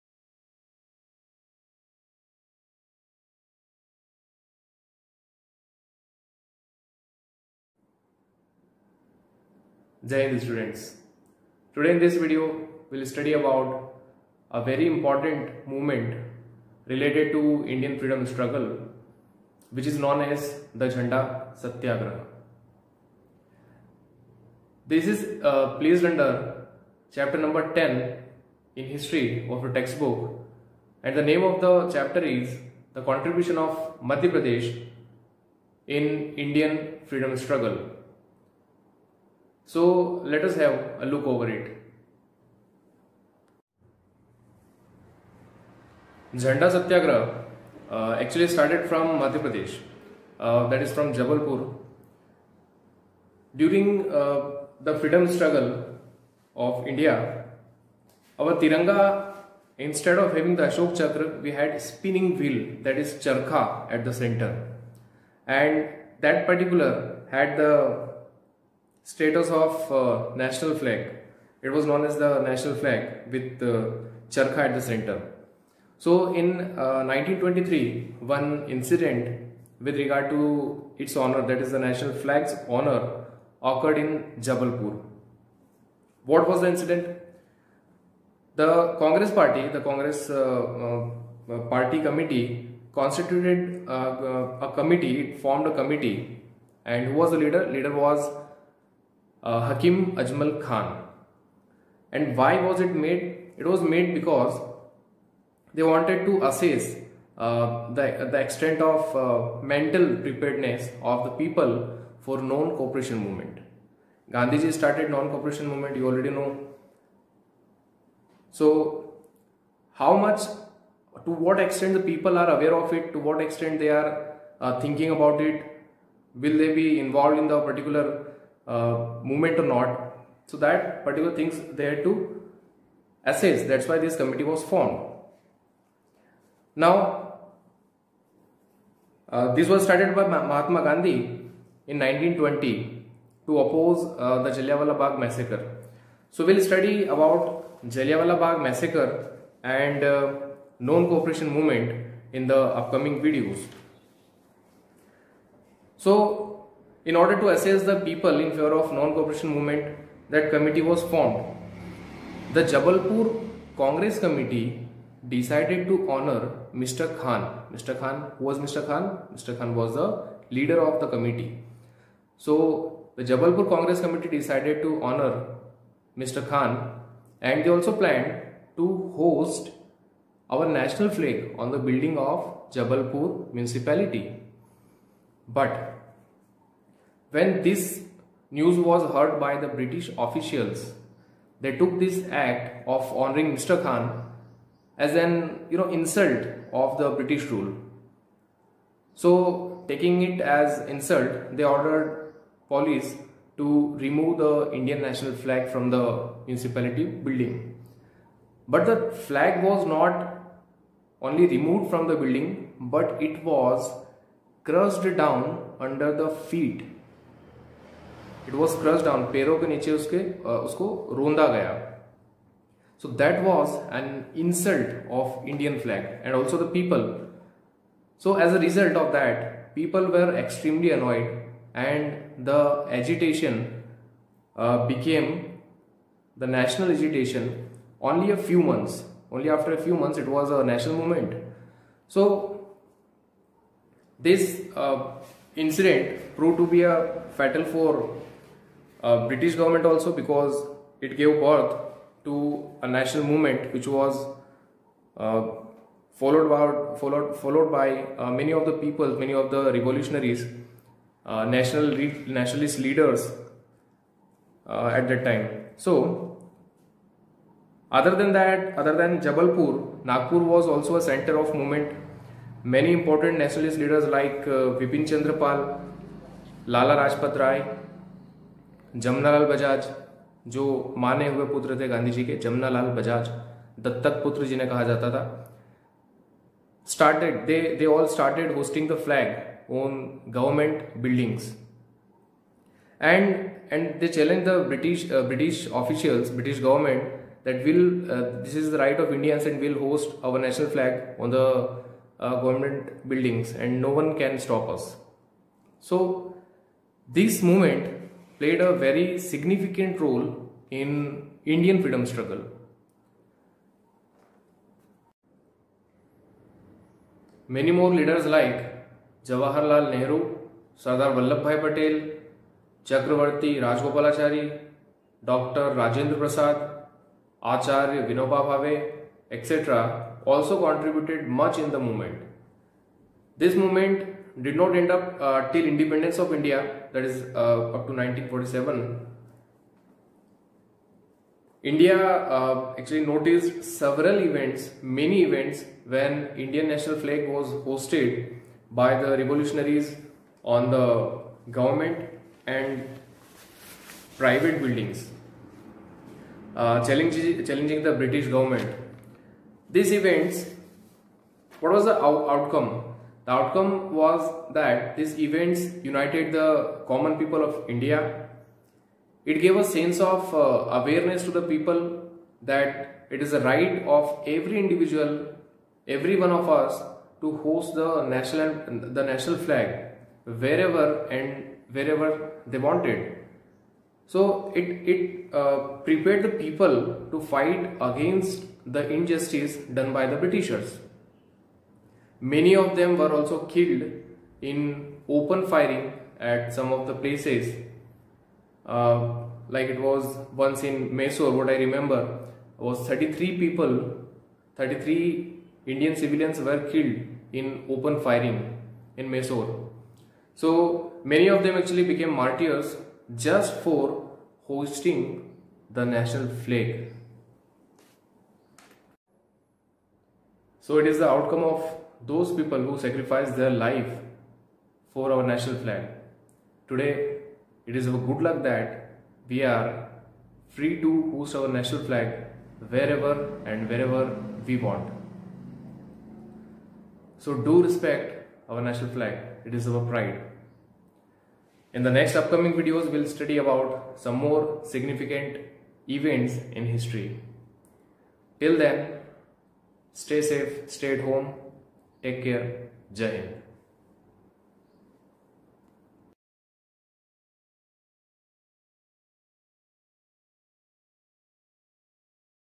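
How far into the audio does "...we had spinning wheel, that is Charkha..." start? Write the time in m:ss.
1:01.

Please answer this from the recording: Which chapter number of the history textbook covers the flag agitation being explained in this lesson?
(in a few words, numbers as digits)
10.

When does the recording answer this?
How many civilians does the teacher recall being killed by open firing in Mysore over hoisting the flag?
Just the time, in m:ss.
6:44.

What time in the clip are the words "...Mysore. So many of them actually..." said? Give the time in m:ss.
6:49.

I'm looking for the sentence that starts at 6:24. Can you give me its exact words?
So it it uh, prepared the people to fight against the injustice done by the Britishers.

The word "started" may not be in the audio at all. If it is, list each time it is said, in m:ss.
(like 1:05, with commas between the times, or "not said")
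0:48, 1:54, 2:19.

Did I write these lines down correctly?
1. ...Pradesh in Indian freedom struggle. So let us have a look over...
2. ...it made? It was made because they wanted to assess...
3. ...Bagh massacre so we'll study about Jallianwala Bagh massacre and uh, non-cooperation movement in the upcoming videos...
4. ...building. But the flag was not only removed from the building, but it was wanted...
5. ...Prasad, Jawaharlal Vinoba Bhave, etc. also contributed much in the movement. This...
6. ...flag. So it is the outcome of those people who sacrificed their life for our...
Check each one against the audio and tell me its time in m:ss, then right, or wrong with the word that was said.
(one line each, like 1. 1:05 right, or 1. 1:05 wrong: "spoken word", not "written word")
1. 0:34 right
2. 1:42 right
3. 2:24 right
4. 3:27 wrong: "crushed", not "wanted"
5. 5:26 wrong: "Acharya", not "Jawaharlal"
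6. 6:56 right.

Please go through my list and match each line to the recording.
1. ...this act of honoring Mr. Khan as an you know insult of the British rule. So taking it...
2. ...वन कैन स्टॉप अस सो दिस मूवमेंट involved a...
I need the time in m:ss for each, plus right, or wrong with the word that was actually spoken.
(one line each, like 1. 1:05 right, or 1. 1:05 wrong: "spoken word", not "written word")
1. 3:11 right
2. 5:04 wrong: "played", not "involved".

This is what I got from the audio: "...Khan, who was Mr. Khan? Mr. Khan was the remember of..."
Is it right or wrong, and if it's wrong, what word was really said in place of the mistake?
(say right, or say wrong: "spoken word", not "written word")
wrong: "leader", not "remember".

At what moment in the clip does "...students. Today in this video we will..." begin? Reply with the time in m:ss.
0:10.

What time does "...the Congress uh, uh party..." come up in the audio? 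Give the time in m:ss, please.
1:29.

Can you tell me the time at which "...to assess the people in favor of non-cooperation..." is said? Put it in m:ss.
2:37.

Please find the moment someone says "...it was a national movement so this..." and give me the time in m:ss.
4:00.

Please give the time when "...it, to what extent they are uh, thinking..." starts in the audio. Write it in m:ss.
2:02.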